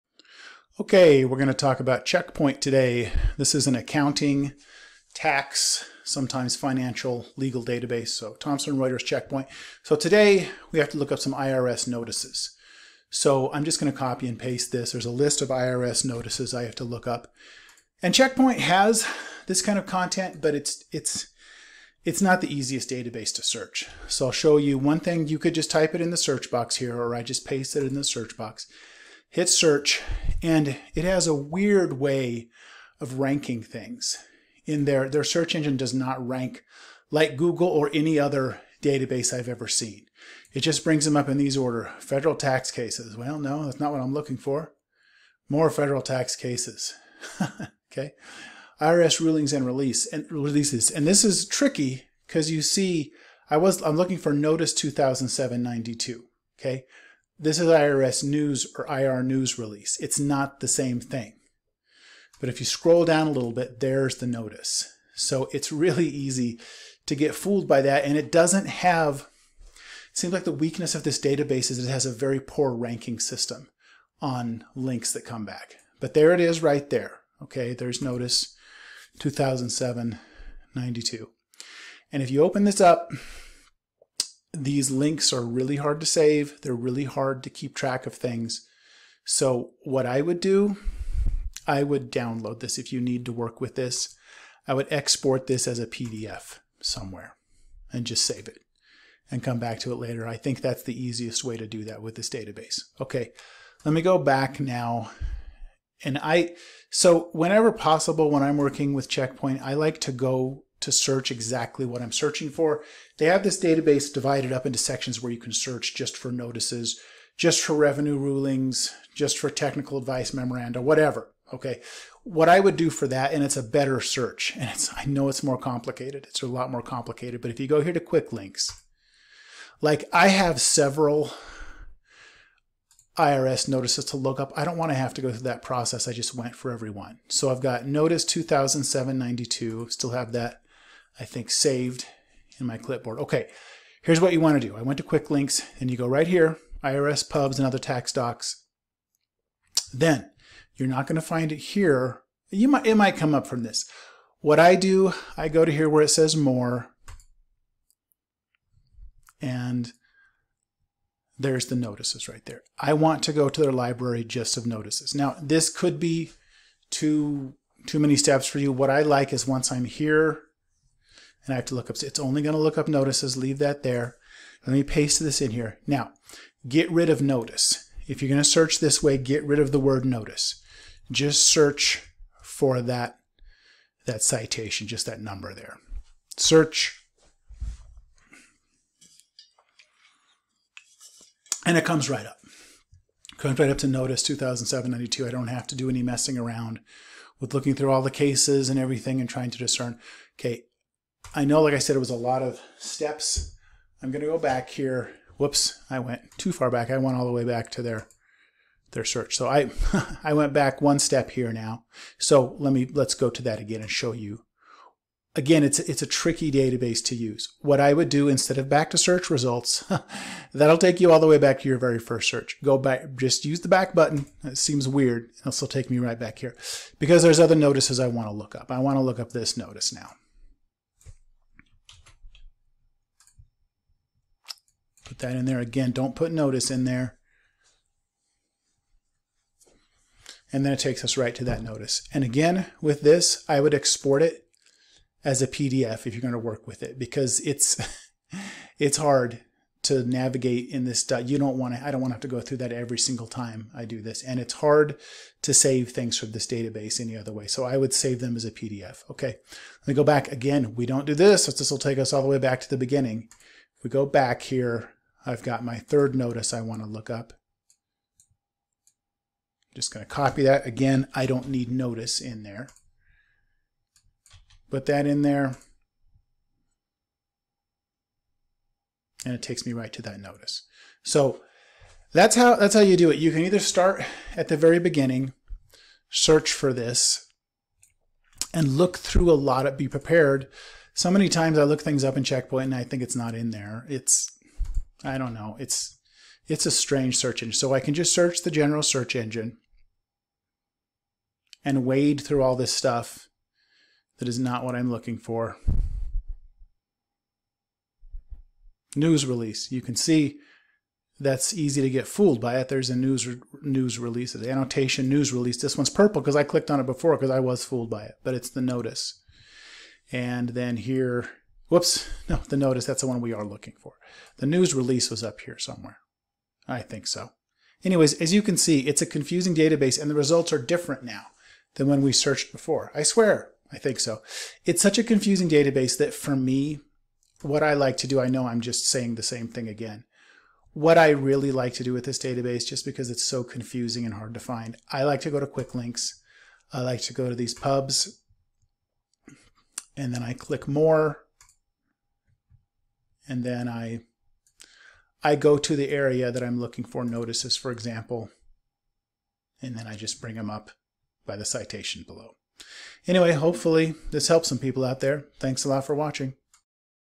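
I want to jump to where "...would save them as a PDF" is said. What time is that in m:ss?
4:17.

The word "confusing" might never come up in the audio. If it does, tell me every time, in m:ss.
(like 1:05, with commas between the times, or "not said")
5:29, 5:35, 5:43.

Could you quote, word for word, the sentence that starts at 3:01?
Just search for that, that citation, just that number there.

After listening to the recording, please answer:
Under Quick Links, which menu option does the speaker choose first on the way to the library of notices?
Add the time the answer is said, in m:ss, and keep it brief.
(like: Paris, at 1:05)
IRS pubs and other tax docs, at 2:26.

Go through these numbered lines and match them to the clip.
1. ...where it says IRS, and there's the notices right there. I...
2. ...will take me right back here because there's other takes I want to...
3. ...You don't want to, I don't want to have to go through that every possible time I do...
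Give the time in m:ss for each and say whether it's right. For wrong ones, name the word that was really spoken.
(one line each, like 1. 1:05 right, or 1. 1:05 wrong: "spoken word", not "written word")
1. 2:35 wrong: "More", not "IRS"
2. 3:45 wrong: "notices", not "takes"
3. 4:11 wrong: "single", not "possible".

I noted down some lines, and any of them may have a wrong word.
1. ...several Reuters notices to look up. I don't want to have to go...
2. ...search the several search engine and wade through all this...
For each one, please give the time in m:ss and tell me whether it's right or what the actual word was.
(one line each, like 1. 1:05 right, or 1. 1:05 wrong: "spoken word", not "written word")
1. 2:10 wrong: "IRS", not "Reuters"
2. 4:58 wrong: "general", not "several".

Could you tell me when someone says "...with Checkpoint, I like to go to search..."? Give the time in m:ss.
1:48.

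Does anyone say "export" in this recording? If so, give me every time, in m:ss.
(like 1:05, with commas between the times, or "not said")
1:34, 4:03.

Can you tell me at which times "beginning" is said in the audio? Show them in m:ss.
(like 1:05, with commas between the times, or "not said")
4:22, 4:44.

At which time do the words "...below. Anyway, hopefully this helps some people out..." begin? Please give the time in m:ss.
6:02.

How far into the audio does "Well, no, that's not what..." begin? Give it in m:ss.
0:43.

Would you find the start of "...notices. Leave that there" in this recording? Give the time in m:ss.
2:52.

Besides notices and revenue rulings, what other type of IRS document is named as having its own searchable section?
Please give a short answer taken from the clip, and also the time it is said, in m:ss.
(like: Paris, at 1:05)
Technical advice memoranda, at 1:59.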